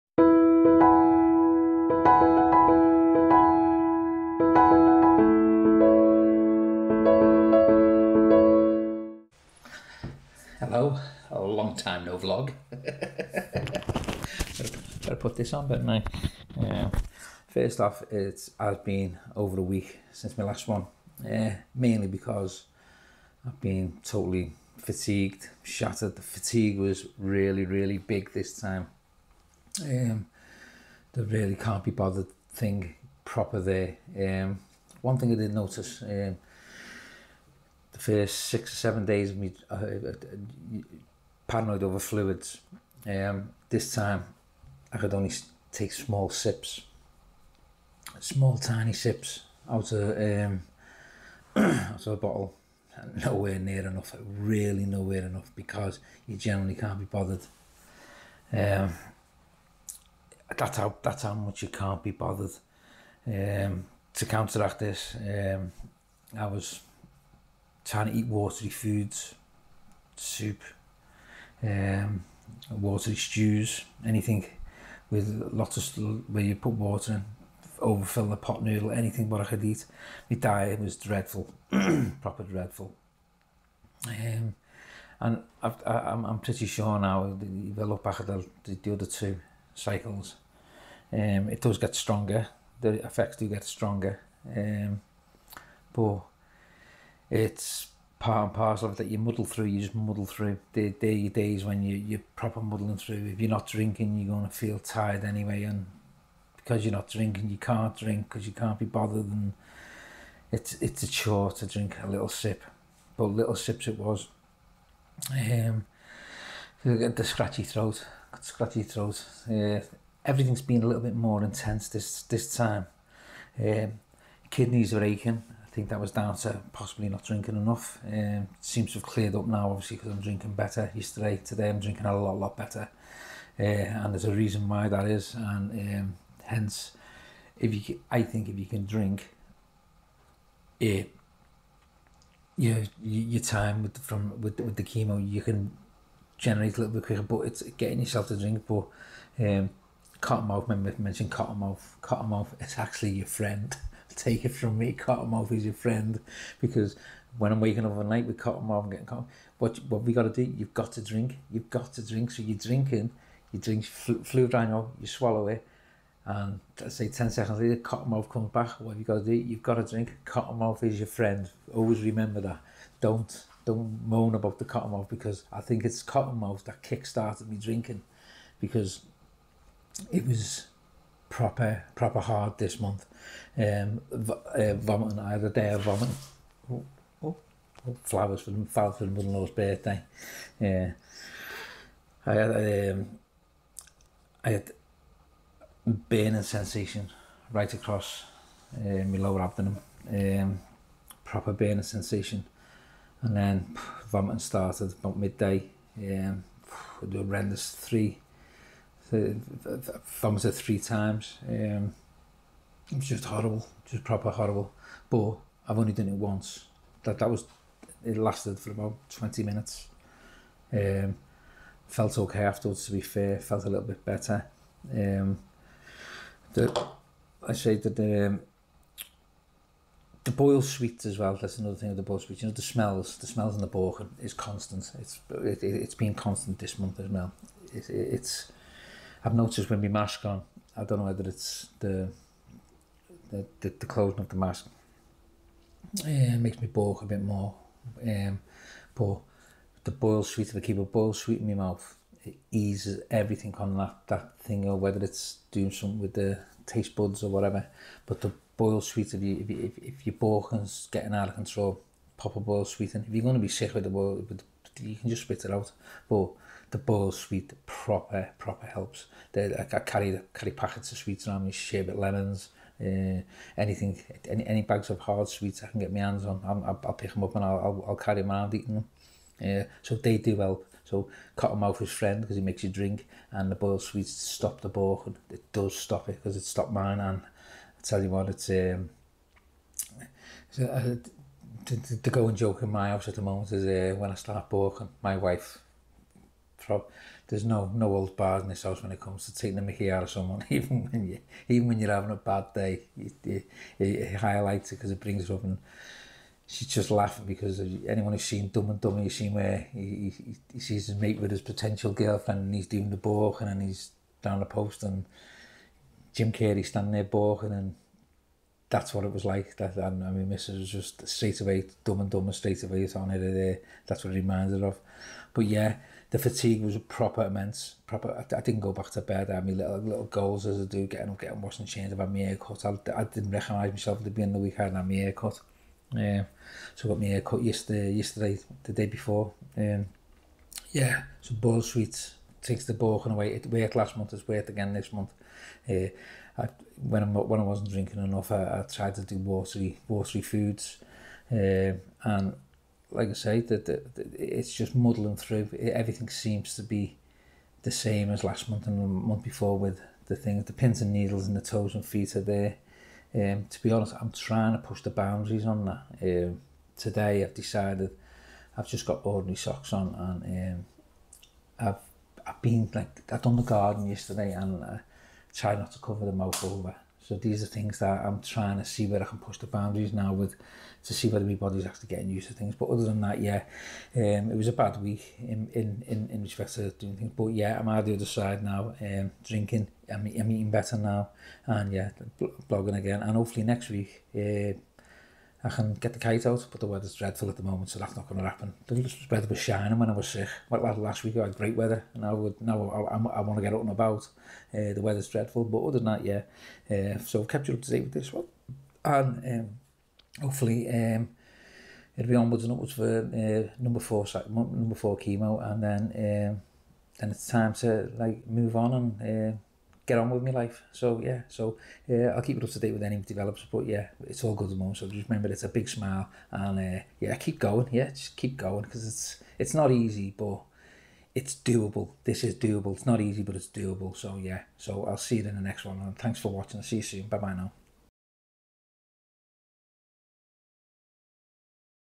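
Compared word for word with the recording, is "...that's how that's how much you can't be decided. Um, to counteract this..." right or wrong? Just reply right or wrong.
wrong.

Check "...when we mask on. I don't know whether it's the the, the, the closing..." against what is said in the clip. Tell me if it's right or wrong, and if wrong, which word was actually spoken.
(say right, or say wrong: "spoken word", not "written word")
right.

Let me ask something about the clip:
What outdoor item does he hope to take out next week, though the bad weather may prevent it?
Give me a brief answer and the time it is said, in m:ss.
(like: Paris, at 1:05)
The kite, at 6:35.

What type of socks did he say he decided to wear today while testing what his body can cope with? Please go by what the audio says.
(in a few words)
Ordinary socks.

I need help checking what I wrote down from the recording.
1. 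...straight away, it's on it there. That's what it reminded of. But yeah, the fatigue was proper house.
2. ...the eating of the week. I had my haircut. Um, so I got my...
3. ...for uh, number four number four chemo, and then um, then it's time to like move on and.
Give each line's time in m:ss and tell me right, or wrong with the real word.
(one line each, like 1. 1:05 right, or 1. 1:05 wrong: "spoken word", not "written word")
1. 5:22 wrong: "immense", not "house"
2. 5:34 wrong: "beginning", not "eating"
3. 6:52 right.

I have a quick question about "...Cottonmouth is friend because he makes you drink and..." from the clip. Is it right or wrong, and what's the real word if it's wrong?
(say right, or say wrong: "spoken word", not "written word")
right.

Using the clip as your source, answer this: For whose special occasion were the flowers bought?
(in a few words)
Mother-in-law's birthday.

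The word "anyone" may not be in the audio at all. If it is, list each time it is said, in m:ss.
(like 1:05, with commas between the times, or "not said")
5:07.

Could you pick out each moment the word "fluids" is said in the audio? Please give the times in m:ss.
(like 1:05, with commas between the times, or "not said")
0:41, 2:43.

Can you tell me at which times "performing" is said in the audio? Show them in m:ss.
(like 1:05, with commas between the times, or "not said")
not said.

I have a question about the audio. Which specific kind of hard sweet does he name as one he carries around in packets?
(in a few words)
Sherbet lemons.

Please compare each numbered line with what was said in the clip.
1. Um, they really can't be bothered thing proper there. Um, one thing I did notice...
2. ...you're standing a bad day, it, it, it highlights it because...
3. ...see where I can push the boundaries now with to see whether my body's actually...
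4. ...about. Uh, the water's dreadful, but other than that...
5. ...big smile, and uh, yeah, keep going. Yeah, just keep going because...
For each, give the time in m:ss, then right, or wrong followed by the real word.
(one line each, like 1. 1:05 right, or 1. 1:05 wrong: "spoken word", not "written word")
1. 0:29 right
2. 5:01 wrong: "having", not "standing"
3. 6:18 right
4. 6:43 wrong: "weather", not "water"
5. 7:05 right.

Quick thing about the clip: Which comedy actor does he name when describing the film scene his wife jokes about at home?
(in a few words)
Jim Carrey.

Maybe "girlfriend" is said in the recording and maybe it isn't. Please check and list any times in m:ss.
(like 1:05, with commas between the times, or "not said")
5:11.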